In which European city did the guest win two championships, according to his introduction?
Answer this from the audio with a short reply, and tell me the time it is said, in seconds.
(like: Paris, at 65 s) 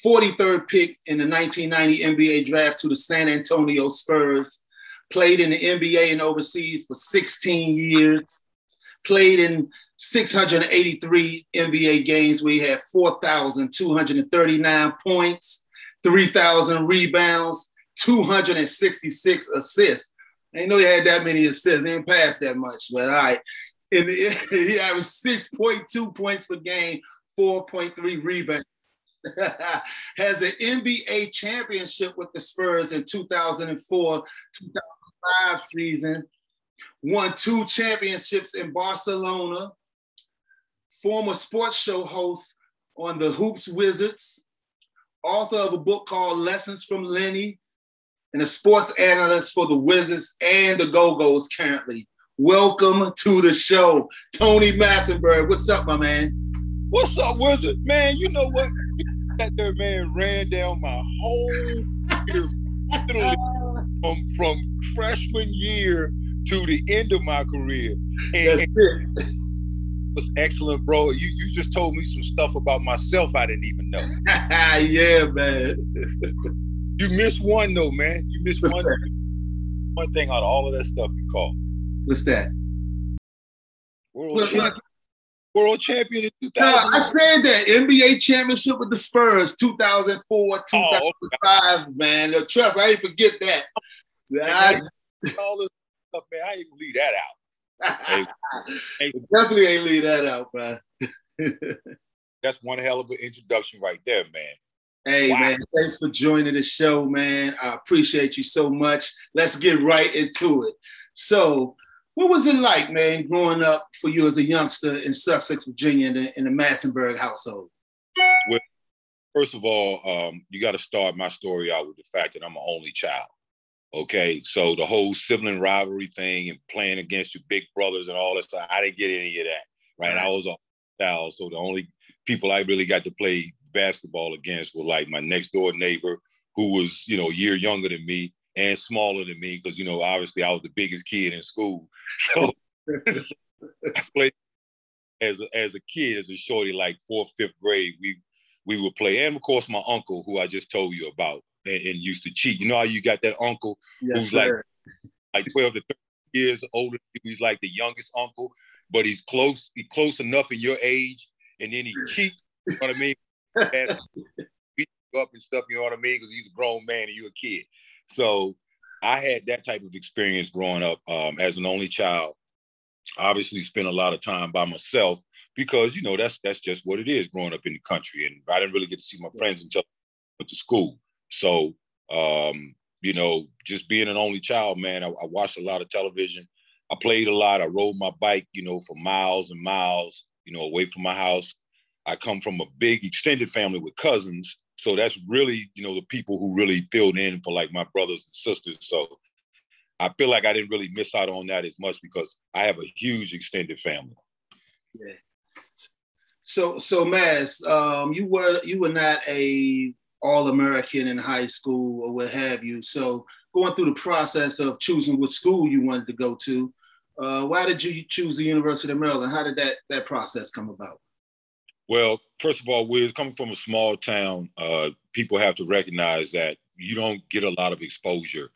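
Barcelona, at 38 s.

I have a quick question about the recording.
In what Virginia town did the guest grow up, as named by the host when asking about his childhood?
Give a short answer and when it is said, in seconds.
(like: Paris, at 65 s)
Sussex, at 115 s.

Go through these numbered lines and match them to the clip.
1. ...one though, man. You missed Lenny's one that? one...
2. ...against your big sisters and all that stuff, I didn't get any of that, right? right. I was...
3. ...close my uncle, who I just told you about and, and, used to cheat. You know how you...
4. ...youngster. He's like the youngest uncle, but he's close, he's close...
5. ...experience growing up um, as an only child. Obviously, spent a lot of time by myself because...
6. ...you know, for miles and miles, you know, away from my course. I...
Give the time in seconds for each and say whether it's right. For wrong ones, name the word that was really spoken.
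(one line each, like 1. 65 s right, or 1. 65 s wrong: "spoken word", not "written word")
1. 77 s wrong: "What", not "Lenny"
2. 126 s wrong: "brothers", not "sisters"
3. 149 s wrong: "course", not "close"
4. 156 s wrong: "older", not "youngster"
5. 169 s right
6. 188 s wrong: "house", not "course".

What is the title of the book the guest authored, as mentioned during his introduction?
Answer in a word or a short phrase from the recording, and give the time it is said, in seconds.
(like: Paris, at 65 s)
Lessons from Lenny, at 46 s.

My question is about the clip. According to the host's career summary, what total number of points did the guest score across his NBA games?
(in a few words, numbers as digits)
4,239.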